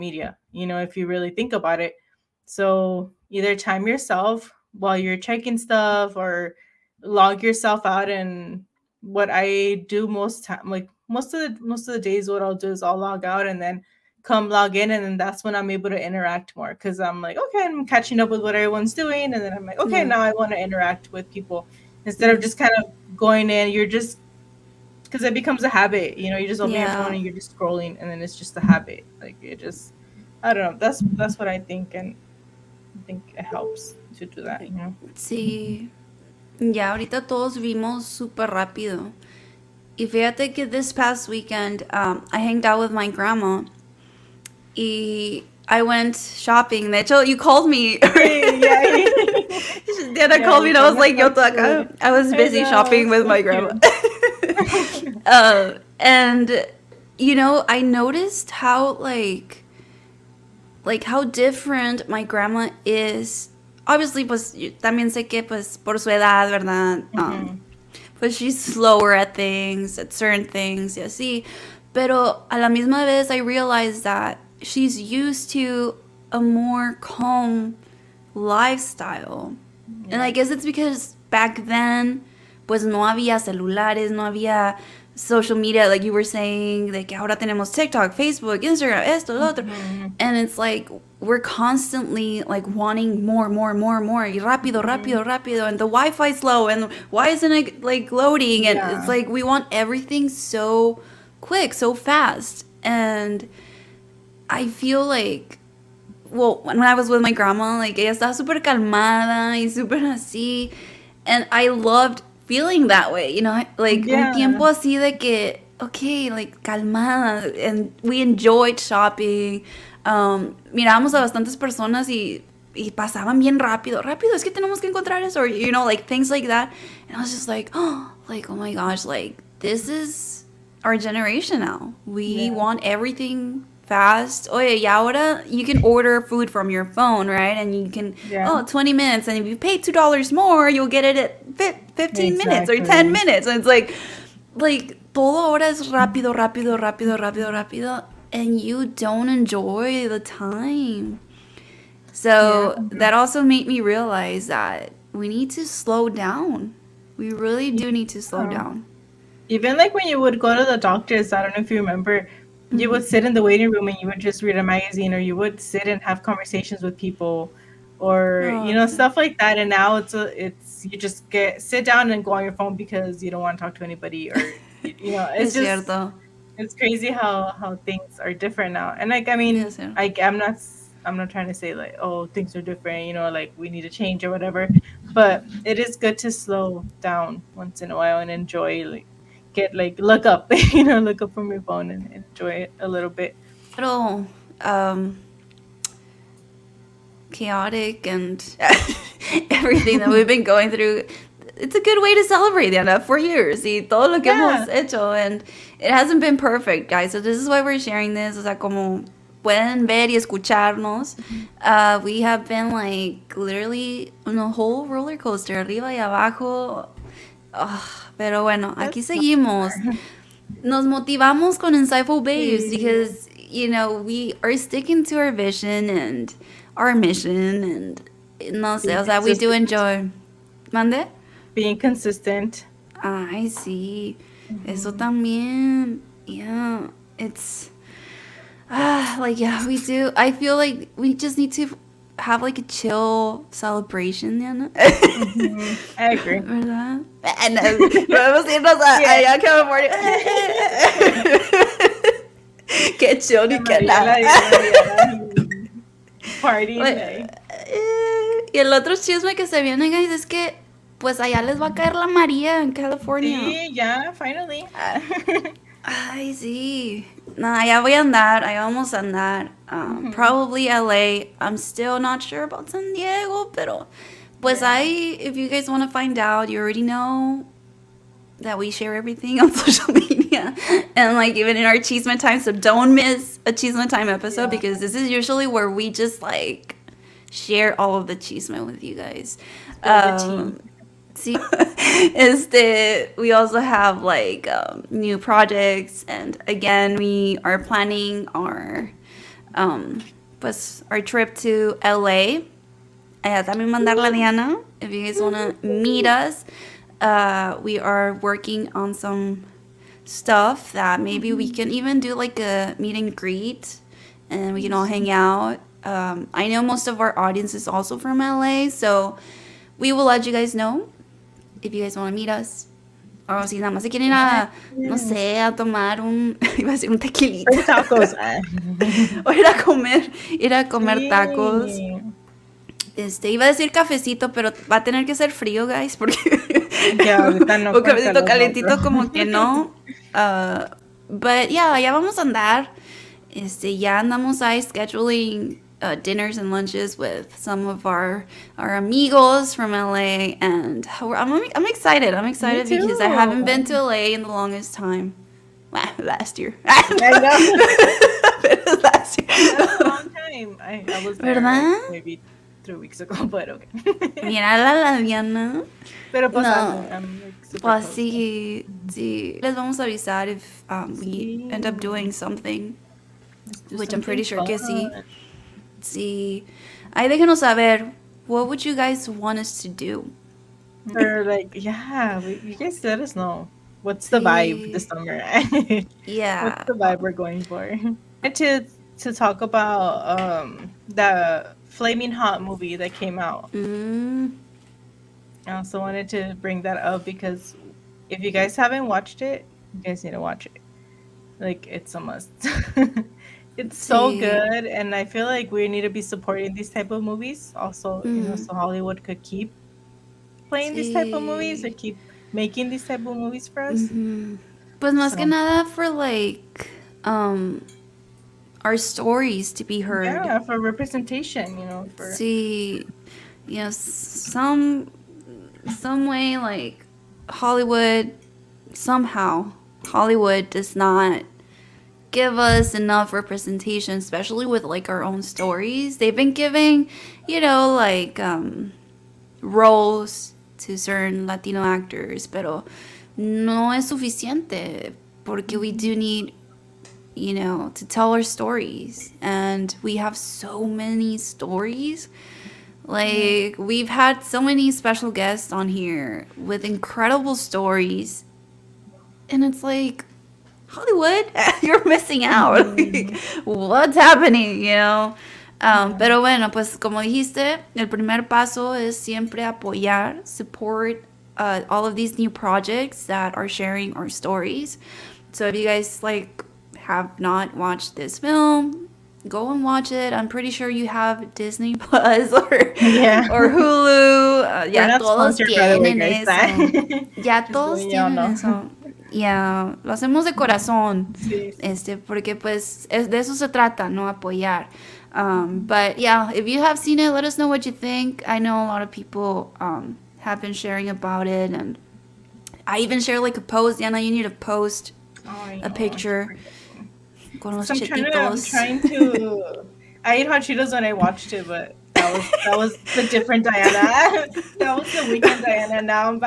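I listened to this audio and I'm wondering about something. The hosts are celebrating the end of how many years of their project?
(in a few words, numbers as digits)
4.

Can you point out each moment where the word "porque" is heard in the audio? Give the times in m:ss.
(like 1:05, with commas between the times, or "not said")
5:35, 7:25, 8:11.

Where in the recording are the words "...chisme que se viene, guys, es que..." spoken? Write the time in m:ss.
4:18.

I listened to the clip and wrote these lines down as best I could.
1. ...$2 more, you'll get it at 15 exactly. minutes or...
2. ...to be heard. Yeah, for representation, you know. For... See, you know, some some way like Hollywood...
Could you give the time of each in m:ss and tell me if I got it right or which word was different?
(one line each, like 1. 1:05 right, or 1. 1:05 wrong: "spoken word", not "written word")
1. 2:19 right
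2. 6:59 right.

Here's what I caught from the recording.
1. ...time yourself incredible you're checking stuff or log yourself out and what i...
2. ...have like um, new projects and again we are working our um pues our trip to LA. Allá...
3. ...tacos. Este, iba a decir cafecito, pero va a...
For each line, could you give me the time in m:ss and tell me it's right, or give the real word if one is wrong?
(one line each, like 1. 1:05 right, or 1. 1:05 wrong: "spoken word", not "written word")
1. 0:03 wrong: "while", not "incredible"
2. 4:53 wrong: "planning", not "working"
3. 5:31 right.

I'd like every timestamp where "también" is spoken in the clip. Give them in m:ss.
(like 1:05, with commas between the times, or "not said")
1:04, 3:54, 5:03.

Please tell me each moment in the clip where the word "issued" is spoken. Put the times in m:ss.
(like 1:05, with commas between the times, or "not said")
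not said.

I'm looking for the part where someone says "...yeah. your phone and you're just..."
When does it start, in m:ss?
0:26.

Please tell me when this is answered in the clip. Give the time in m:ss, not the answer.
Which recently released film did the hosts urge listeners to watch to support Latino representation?
6:31.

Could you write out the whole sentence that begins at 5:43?
Este, ya andamos ahí scheduling uh, dinners and lunches with some of our our amigos from LA, and I'm I'm excited.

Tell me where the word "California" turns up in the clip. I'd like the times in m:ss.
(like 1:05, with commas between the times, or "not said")
4:09, 4:22.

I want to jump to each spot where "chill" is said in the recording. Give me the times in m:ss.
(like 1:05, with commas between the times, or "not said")
4:02, 4:13.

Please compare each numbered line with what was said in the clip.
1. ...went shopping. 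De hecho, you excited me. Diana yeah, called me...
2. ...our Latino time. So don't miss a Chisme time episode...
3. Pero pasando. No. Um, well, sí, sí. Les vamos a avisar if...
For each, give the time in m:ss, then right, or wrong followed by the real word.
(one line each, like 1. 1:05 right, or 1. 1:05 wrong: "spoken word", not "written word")
1. 0:45 wrong: "called", not "excited"
2. 4:41 wrong: "Chisme", not "Latino"
3. 6:06 right.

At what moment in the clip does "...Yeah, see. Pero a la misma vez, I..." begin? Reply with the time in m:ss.
1:10.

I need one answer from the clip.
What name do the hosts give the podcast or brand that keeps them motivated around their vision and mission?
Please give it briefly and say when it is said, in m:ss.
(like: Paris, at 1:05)
Insightful Babes, at 3:41.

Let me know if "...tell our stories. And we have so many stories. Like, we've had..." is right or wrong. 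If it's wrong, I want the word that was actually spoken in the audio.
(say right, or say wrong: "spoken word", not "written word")
right.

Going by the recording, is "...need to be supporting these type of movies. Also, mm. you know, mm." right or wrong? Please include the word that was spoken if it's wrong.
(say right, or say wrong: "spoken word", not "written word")
right.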